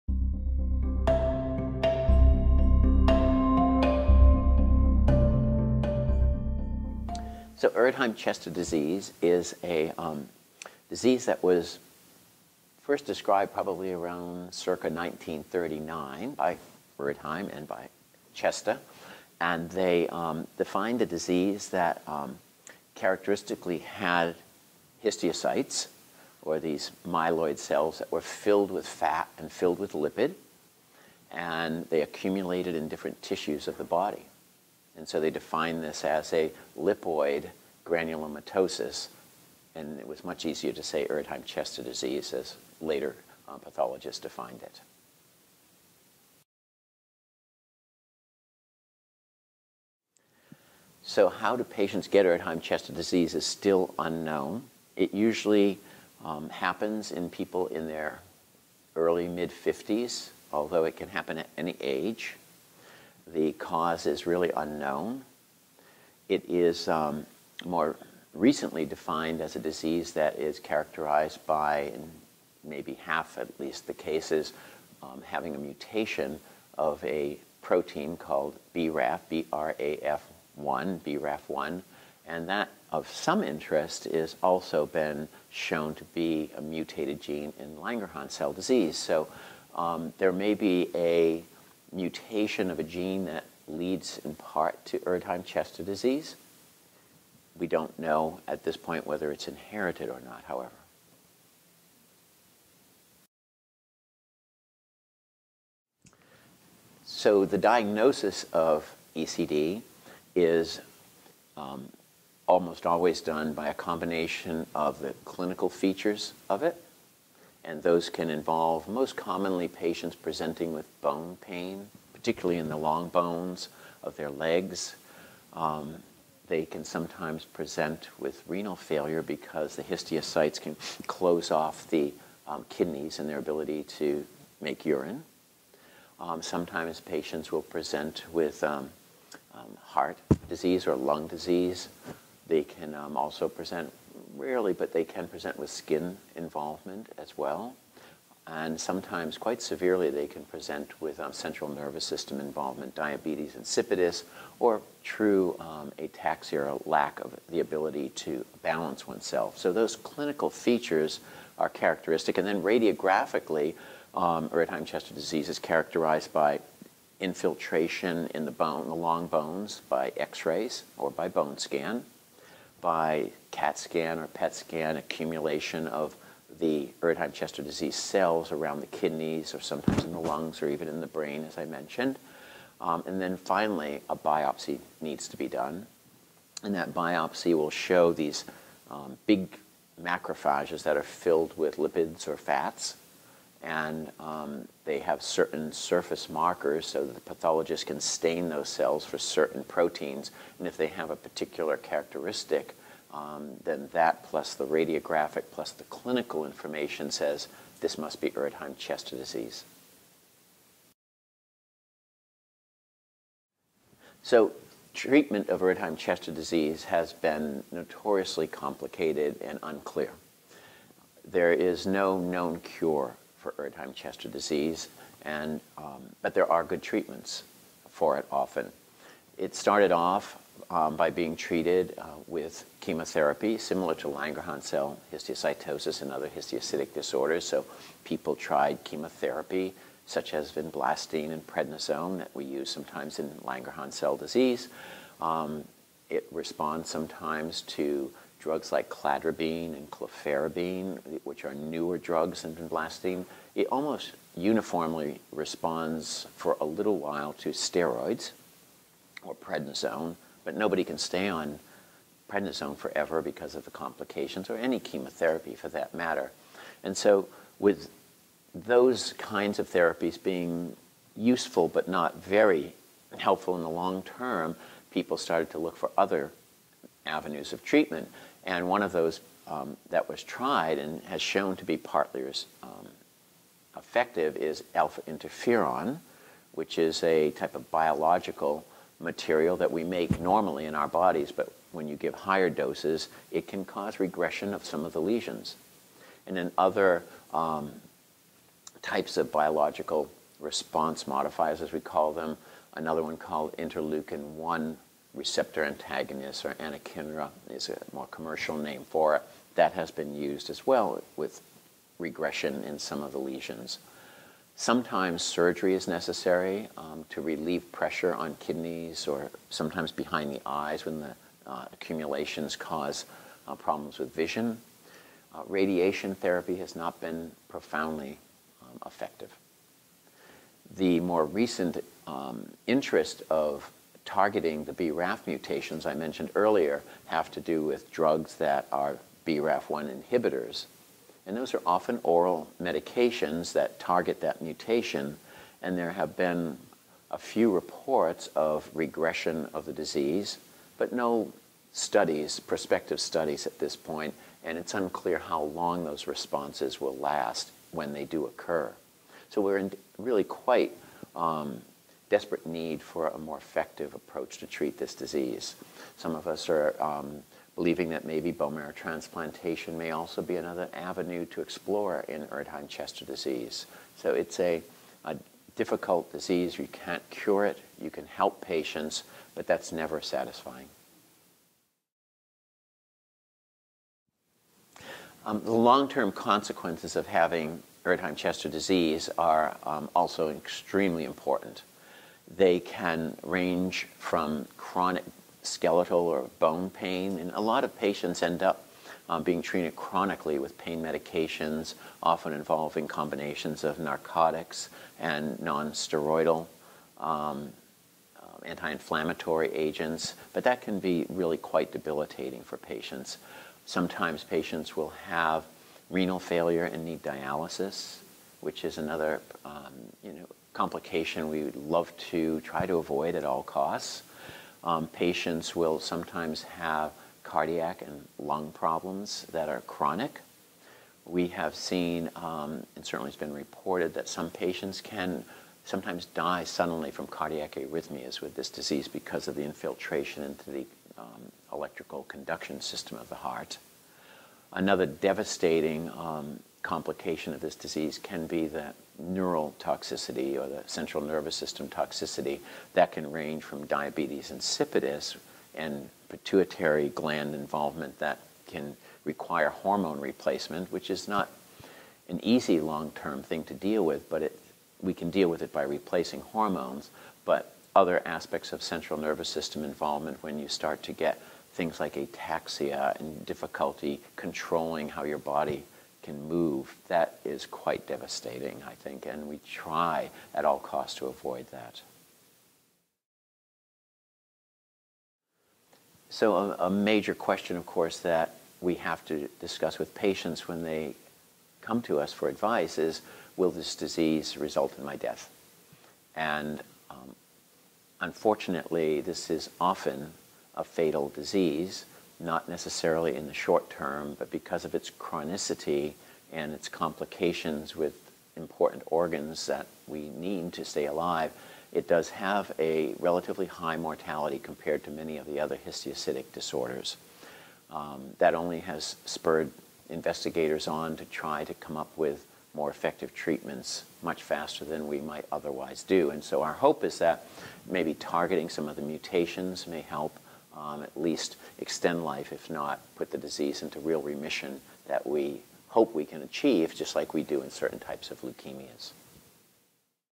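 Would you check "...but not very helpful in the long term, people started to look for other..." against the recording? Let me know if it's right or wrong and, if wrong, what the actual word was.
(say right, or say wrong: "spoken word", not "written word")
right.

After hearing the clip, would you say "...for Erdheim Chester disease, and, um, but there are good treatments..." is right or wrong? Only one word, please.
right.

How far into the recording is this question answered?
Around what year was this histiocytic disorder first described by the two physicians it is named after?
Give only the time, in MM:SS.
00:14.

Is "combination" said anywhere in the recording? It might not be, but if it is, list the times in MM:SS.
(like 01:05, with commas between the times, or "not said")
01:53, 06:42.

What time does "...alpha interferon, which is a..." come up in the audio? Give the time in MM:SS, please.
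04:44.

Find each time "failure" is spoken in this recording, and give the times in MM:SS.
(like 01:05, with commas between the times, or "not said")
02:08, 06:56.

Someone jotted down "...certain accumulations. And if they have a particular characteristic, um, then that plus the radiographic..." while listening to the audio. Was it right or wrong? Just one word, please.
wrong.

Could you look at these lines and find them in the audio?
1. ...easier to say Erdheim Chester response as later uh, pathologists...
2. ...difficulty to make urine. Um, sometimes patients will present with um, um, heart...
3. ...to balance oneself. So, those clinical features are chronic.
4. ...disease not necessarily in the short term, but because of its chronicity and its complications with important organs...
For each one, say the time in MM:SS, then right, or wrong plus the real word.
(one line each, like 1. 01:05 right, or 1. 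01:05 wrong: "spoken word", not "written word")
1. 00:40 wrong: "disease", not "response"
2. 02:13 wrong: "ability", not "difficulty"
3. 02:38 wrong: "characteristic", not "chronic"
4. 08:21 right.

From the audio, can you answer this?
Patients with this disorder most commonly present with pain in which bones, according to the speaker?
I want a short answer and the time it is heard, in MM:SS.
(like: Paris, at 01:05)
long bones of their legs, at 02:02.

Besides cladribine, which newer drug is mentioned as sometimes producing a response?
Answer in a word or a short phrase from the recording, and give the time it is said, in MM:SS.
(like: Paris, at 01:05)
clofarabine, at 04:09.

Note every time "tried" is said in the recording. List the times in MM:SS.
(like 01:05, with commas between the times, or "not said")
03:58, 04:40.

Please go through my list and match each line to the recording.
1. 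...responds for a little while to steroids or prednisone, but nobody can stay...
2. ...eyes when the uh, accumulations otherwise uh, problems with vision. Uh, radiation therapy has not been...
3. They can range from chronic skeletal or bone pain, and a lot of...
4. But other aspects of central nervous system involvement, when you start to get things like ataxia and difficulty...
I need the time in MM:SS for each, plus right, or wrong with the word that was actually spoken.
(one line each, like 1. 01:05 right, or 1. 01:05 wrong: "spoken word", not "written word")
1. 04:15 right
2. 05:20 wrong: "cause", not "otherwise"
3. 06:32 right
4. 07:47 right.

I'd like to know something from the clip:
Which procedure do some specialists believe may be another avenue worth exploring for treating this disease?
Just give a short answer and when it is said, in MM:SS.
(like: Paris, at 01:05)
bone marrow transplantation, at 06:08.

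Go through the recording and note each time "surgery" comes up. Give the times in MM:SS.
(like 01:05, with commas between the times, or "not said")
05:15.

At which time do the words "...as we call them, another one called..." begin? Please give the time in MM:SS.
05:01.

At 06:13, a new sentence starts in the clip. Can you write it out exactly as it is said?
So it's a, a difficult disease.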